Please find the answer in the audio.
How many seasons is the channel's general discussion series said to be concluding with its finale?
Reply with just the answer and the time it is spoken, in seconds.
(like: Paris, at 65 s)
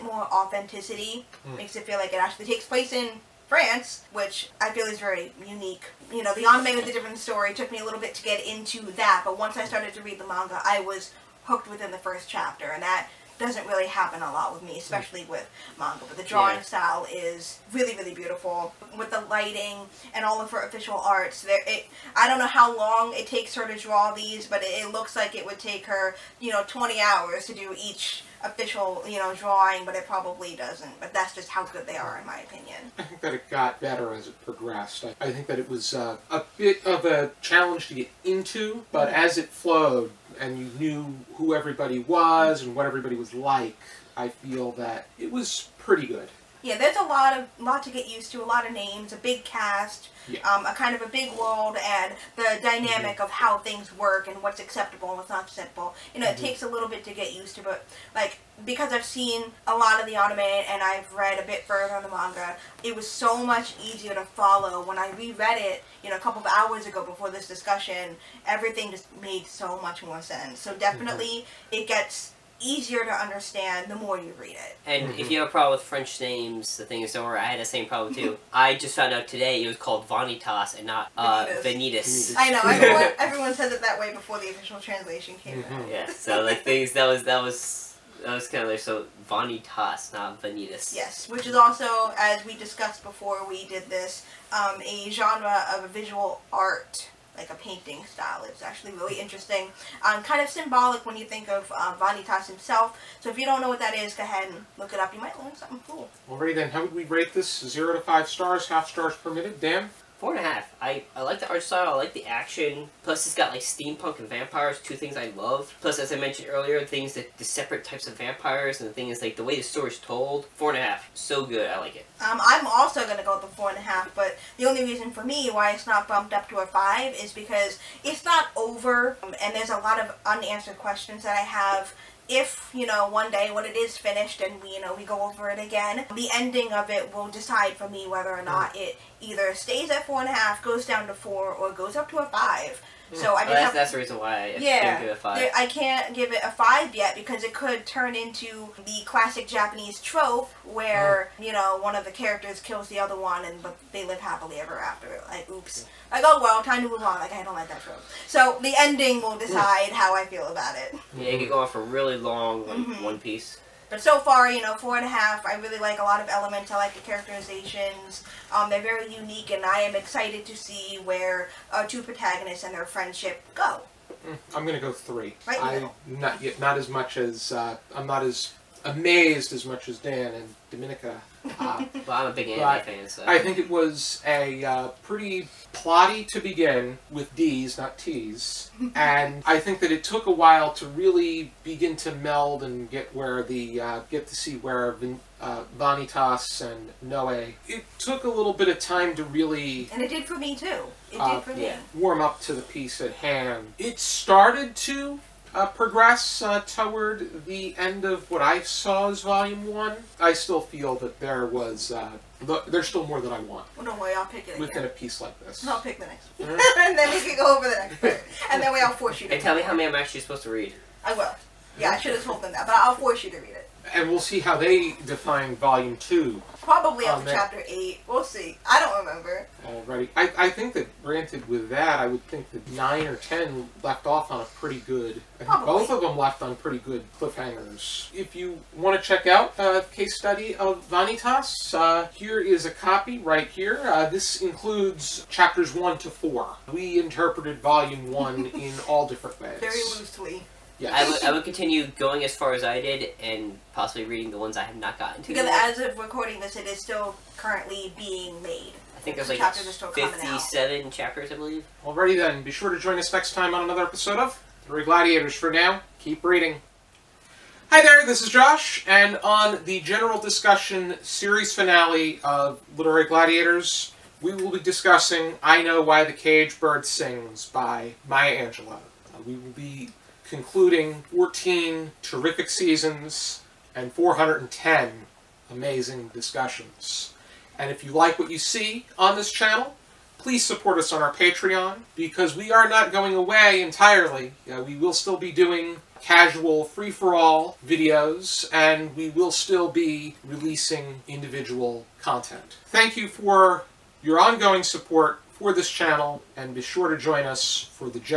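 14, at 281 s.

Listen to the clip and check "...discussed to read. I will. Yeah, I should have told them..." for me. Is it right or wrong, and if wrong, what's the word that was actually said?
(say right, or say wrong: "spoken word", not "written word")
wrong: "supposed", not "discussed".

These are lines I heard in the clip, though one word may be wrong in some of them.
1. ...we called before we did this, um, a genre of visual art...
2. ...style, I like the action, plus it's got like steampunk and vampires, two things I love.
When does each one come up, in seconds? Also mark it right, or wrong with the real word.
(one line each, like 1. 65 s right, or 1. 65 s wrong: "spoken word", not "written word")
1. 92 s wrong: "discussed", not "called"
2. 111 s right.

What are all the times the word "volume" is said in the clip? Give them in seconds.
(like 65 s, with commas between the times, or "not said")
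209 s, 225 s, 247 s.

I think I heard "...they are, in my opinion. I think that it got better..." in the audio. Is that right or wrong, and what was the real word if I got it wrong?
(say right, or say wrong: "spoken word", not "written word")
right.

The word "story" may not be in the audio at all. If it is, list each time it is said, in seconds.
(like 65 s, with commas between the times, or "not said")
7 s, 119 s.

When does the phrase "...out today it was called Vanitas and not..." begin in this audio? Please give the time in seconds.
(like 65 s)
79 s.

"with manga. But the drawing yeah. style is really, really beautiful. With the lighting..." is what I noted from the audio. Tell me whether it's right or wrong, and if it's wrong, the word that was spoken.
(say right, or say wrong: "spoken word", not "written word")
right.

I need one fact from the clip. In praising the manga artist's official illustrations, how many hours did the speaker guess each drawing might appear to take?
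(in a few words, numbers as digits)
20.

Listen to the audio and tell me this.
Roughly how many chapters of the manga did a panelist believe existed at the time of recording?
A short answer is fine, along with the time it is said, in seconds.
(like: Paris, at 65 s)
57, at 259 s.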